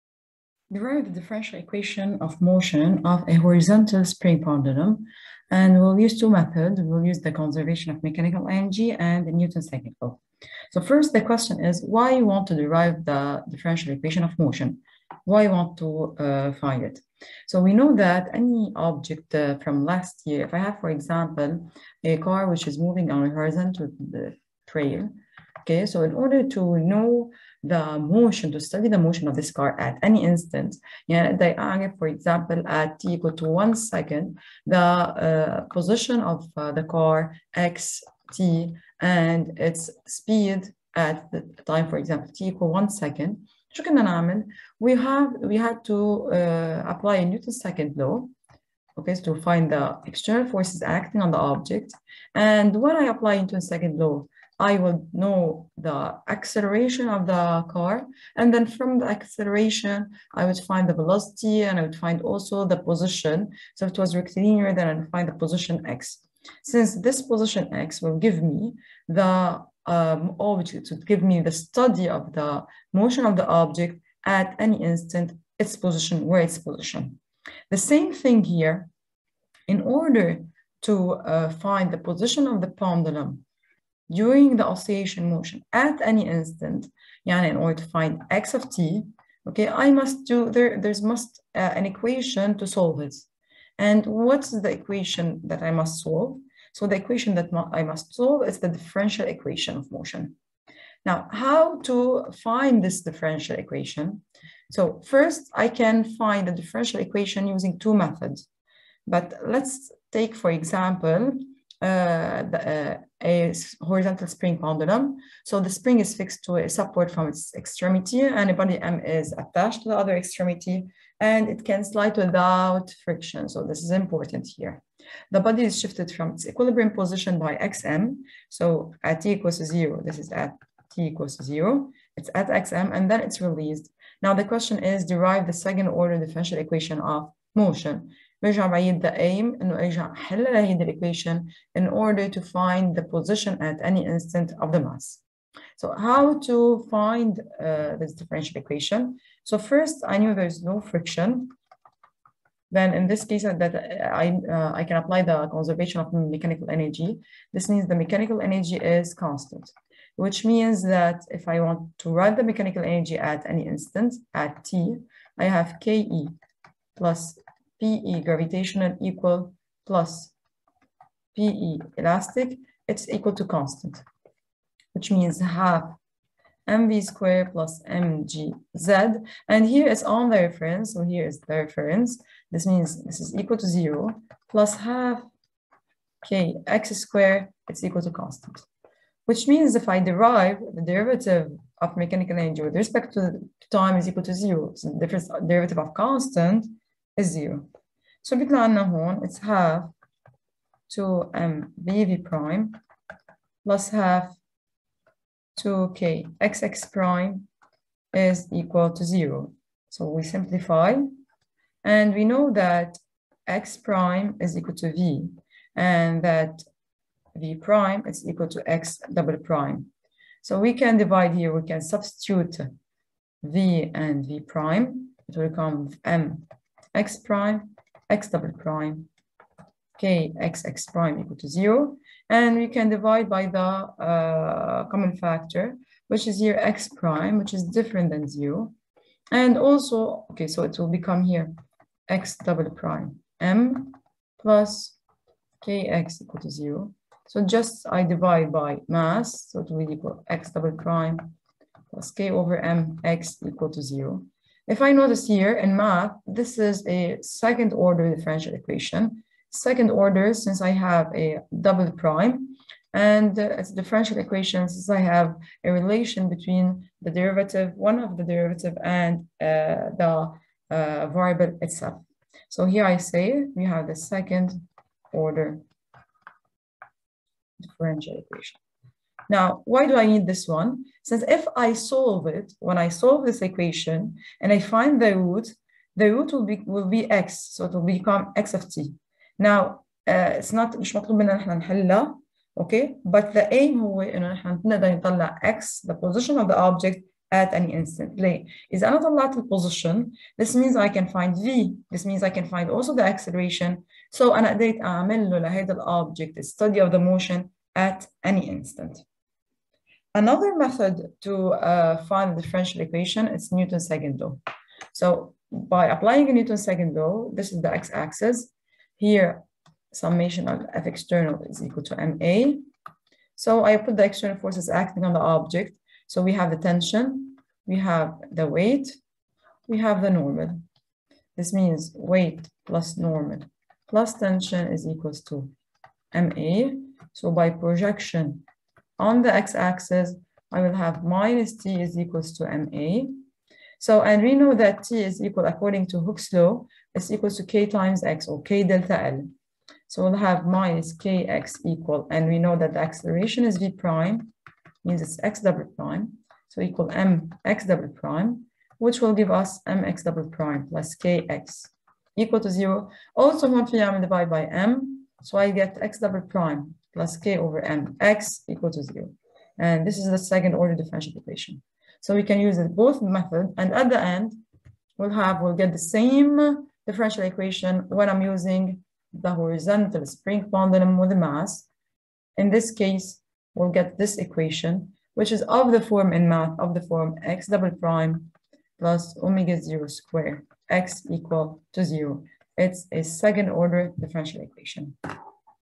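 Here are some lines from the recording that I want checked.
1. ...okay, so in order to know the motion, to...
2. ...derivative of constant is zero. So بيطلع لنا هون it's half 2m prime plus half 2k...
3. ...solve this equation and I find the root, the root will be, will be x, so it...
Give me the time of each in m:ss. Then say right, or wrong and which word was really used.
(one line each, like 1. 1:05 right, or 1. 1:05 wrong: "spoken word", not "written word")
1. 0:25 right
2. 3:15 right
3. 4:42 right.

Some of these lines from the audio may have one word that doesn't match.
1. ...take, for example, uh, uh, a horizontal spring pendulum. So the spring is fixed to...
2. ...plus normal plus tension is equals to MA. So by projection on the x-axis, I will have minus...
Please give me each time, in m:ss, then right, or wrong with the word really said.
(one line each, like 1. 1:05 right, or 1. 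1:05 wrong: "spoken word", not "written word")
1. 1:50 right
2. 5:32 right.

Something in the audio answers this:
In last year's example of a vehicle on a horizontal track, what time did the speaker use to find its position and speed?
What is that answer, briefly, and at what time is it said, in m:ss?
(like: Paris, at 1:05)
1 second, at 0:42.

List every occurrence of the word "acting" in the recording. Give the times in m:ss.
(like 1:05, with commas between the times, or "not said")
0:50, 5:24.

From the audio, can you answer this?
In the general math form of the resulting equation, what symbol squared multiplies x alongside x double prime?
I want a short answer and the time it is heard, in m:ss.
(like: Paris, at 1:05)
omega zero, at 6:29.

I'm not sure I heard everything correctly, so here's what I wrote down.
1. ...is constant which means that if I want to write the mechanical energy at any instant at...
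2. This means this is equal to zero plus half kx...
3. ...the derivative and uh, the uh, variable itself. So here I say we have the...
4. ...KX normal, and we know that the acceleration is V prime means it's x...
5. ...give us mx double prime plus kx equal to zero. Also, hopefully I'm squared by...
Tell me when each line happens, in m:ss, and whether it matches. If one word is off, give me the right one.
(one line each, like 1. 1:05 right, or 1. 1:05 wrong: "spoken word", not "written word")
1. 2:38 right
2. 3:02 right
3. 4:28 right
4. 5:50 wrong: "equal", not "normal"
5. 5:59 wrong: "divided", not "squared".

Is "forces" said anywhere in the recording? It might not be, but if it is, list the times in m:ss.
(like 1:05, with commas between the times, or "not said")
0:50, 5:24.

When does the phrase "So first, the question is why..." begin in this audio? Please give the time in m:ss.
0:10.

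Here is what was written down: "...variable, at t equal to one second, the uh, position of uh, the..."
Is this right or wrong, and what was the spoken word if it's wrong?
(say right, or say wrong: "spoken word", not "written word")
wrong: "example", not "variable".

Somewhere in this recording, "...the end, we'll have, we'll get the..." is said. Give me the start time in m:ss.
6:13.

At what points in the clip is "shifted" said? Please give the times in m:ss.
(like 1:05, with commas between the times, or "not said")
2:05.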